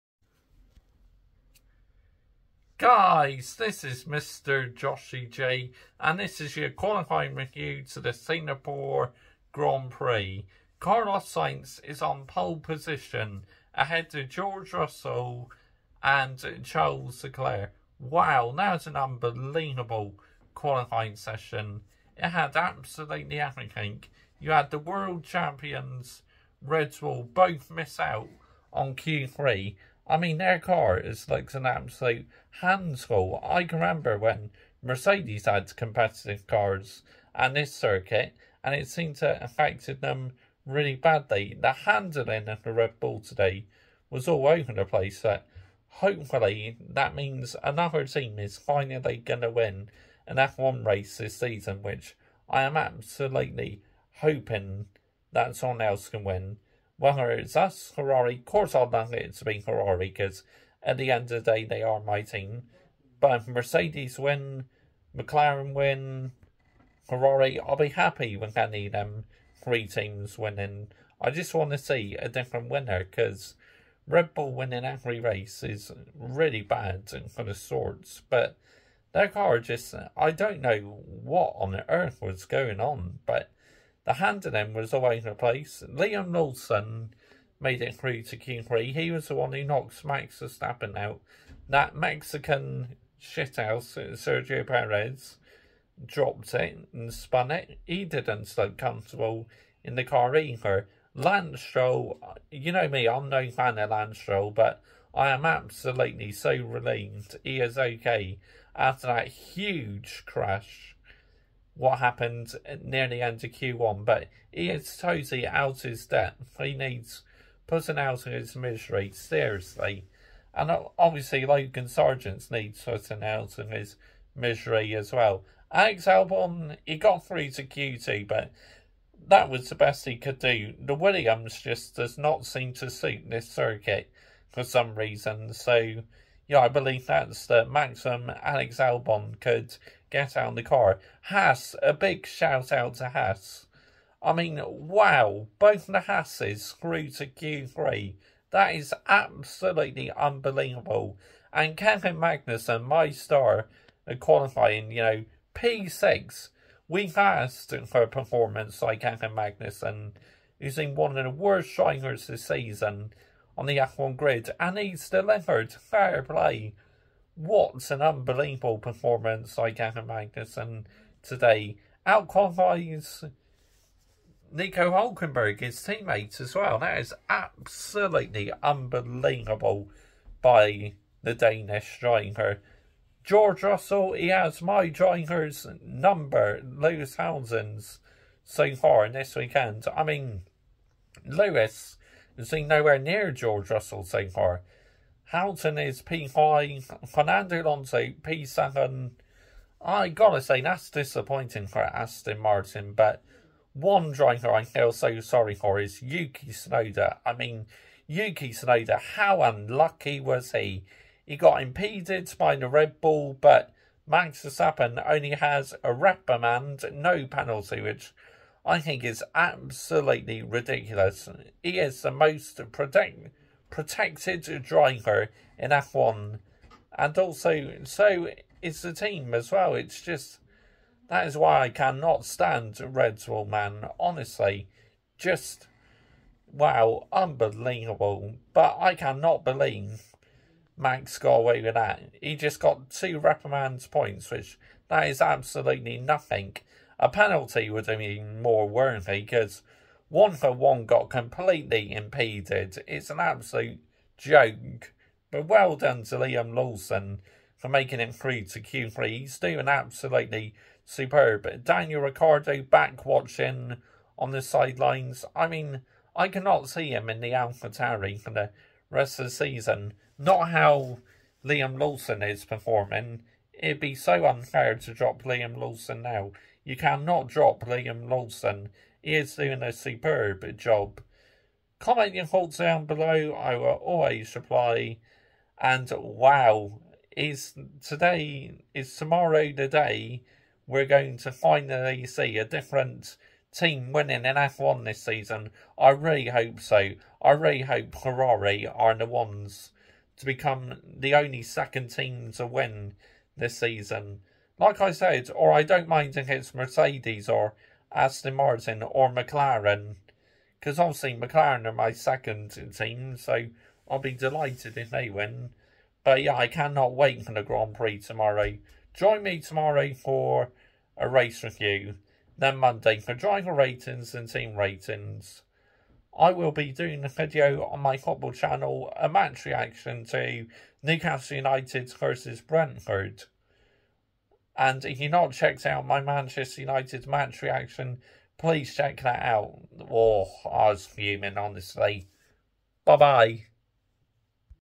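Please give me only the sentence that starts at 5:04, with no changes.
Like I said, or I don't mind against Mercedes or Aston Martin or McLaren.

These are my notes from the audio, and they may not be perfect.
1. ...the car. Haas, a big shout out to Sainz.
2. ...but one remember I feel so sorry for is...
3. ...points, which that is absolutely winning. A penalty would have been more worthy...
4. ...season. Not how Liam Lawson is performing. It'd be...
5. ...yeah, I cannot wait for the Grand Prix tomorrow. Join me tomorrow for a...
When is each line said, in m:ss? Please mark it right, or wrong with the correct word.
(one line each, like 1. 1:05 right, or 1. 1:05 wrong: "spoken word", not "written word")
1. 2:20 wrong: "Haas", not "Sainz"
2. 3:22 wrong: "driver", not "remember"
3. 4:03 wrong: "nothing", not "winning"
4. 4:29 right
5. 5:16 right.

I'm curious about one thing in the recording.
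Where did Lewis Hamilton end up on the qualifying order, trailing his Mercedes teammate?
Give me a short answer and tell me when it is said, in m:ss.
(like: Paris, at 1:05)
P5, at 3:15.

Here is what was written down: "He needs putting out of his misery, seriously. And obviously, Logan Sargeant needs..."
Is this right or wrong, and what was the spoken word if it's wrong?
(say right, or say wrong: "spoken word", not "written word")
right.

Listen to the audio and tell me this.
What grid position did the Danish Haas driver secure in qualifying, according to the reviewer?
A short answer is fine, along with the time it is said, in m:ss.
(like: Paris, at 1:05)
P6, at 2:35.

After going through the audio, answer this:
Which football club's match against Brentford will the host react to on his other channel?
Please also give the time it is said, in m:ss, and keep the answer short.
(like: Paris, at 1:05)
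Newcastle United, at 5:30.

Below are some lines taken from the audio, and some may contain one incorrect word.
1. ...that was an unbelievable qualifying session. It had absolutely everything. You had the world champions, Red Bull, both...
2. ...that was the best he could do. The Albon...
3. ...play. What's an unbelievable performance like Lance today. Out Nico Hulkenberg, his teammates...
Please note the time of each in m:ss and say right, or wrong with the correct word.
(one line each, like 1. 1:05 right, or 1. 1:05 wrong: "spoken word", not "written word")
1. 0:18 right
2. 2:09 wrong: "Williams", not "Albon"
3. 2:46 wrong: "Magnussen", not "Lance".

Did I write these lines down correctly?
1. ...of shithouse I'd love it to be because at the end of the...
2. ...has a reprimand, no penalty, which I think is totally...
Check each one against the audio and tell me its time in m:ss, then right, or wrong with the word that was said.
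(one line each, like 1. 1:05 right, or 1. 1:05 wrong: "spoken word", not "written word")
1. 0:58 wrong: "course", not "shithouse"
2. 3:35 wrong: "absolutely", not "totally".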